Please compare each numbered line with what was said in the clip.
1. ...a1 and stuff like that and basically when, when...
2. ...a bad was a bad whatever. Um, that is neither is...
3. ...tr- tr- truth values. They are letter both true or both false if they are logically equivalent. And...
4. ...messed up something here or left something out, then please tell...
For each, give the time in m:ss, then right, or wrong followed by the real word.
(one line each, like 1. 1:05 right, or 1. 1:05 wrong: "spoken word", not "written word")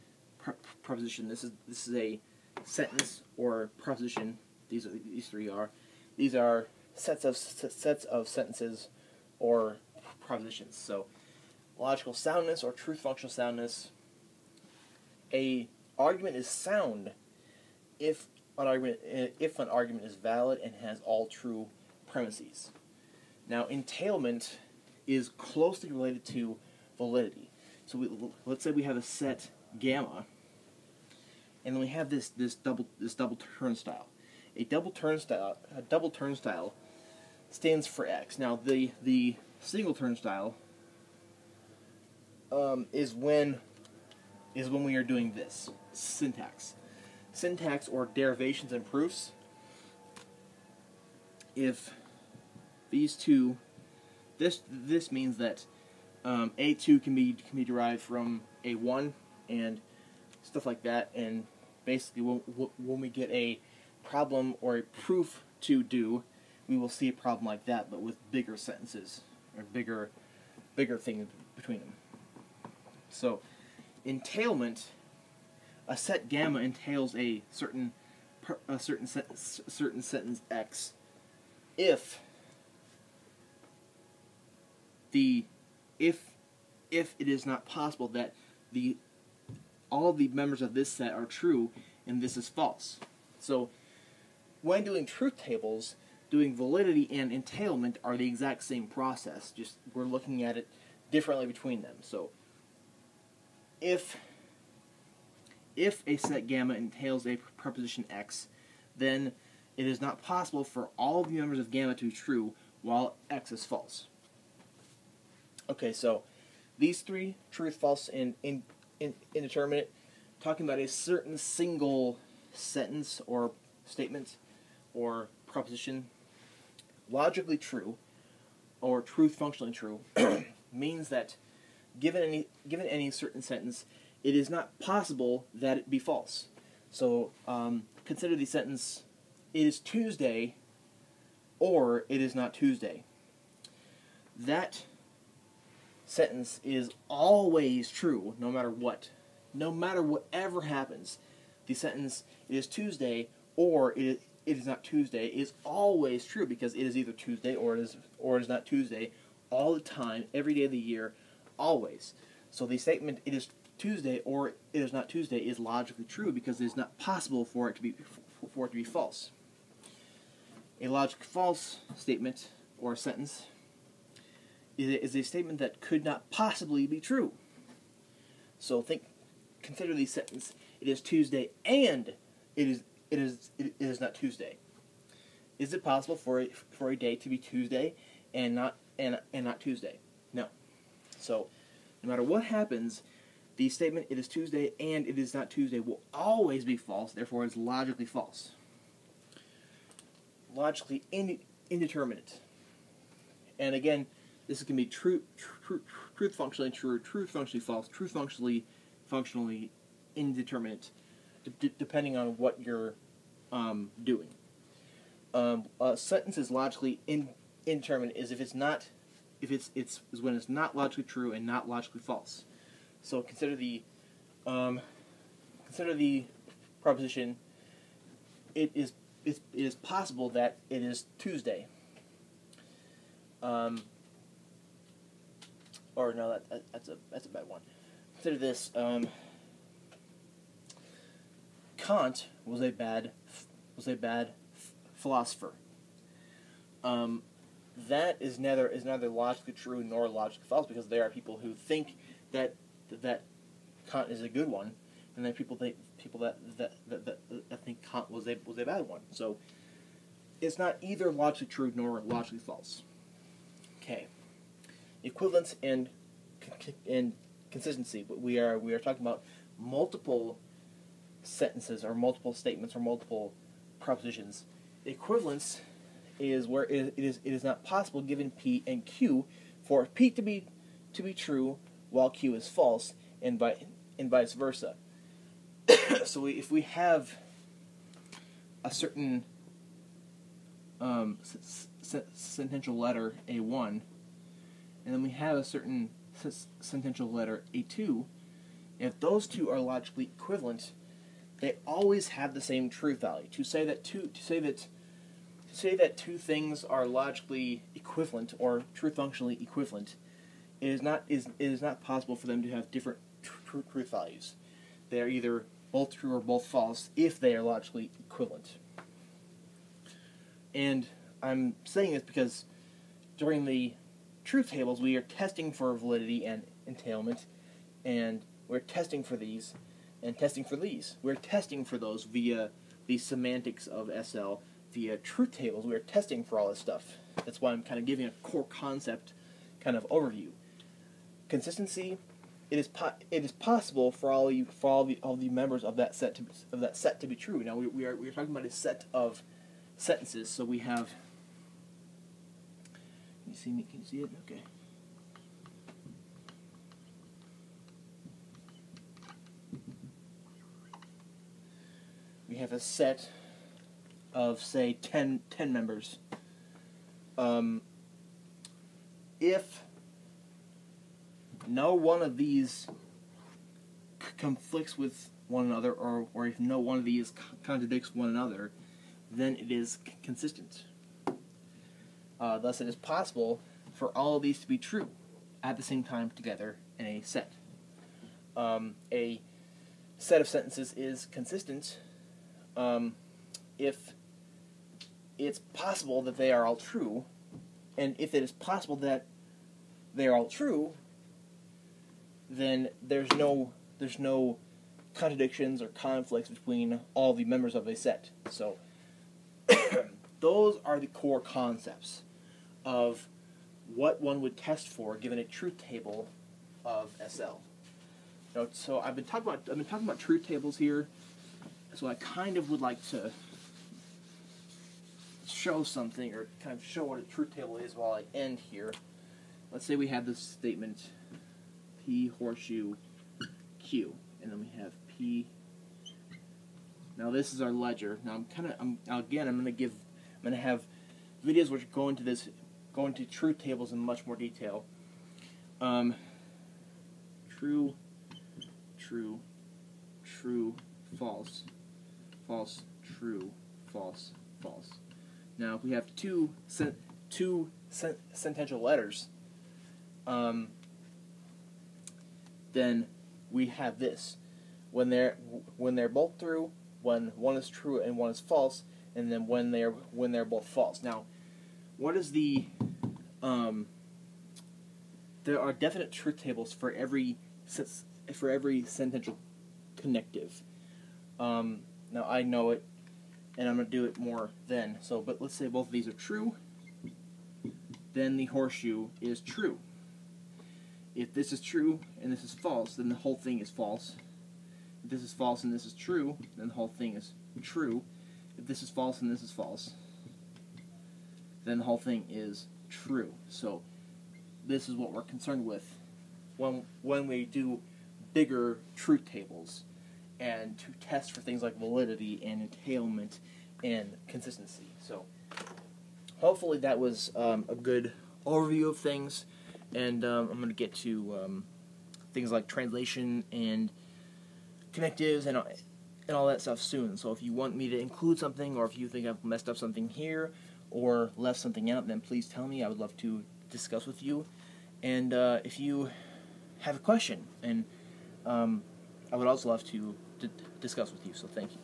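1. 0:58 right
2. 4:02 wrong: "philosopher", not "whatever"
3. 5:13 wrong: "either", not "letter"
4. 8:49 right.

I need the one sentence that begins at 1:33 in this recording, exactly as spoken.
So when doing truth tables, doing validity and entailment are the exact same process, just we're looking at it differently between them.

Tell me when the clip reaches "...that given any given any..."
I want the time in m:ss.
2:11.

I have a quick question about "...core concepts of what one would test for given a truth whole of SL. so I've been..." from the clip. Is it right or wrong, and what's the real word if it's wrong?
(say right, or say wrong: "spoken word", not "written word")
wrong: "table", not "whole".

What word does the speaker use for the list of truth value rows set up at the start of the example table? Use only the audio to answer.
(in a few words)
ledger.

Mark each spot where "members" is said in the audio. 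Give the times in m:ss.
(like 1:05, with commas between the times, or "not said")
1:30, 1:51, 5:45, 6:05, 6:47.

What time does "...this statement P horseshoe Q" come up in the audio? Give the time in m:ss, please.
7:10.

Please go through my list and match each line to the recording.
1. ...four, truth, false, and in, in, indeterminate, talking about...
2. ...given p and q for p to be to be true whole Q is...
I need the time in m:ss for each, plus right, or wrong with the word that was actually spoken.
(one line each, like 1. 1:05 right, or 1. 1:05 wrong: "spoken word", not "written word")
1. 1:57 wrong: "three", not "four"
2. 4:38 wrong: "while", not "whole".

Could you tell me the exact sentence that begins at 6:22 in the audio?
Uh, thus, it is possible for all of these to be true at the same time together in a set.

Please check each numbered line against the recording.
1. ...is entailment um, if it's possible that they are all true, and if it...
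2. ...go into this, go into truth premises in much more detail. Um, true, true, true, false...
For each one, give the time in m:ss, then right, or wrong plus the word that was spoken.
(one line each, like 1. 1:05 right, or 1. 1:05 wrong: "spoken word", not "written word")
1. 6:30 wrong: "consistent", not "entailment"
2. 7:21 wrong: "tables", not "premises".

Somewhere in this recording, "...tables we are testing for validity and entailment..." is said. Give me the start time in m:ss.
5:24.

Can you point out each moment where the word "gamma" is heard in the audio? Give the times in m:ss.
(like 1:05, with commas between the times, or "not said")
0:29, 1:16, 1:46, 1:51.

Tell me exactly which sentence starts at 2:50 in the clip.
A logic false statement or sentence is a statement that could not possibly be true.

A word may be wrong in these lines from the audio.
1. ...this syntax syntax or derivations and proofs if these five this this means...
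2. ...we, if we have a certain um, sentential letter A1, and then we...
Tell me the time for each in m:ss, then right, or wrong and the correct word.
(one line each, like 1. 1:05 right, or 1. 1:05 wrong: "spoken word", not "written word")
1. 0:45 wrong: "two", not "five"
2. 4:46 right.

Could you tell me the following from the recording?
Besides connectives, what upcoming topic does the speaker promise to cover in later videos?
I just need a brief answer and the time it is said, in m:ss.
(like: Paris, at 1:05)
translation, at 8:42.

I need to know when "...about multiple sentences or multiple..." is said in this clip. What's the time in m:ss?
4:29.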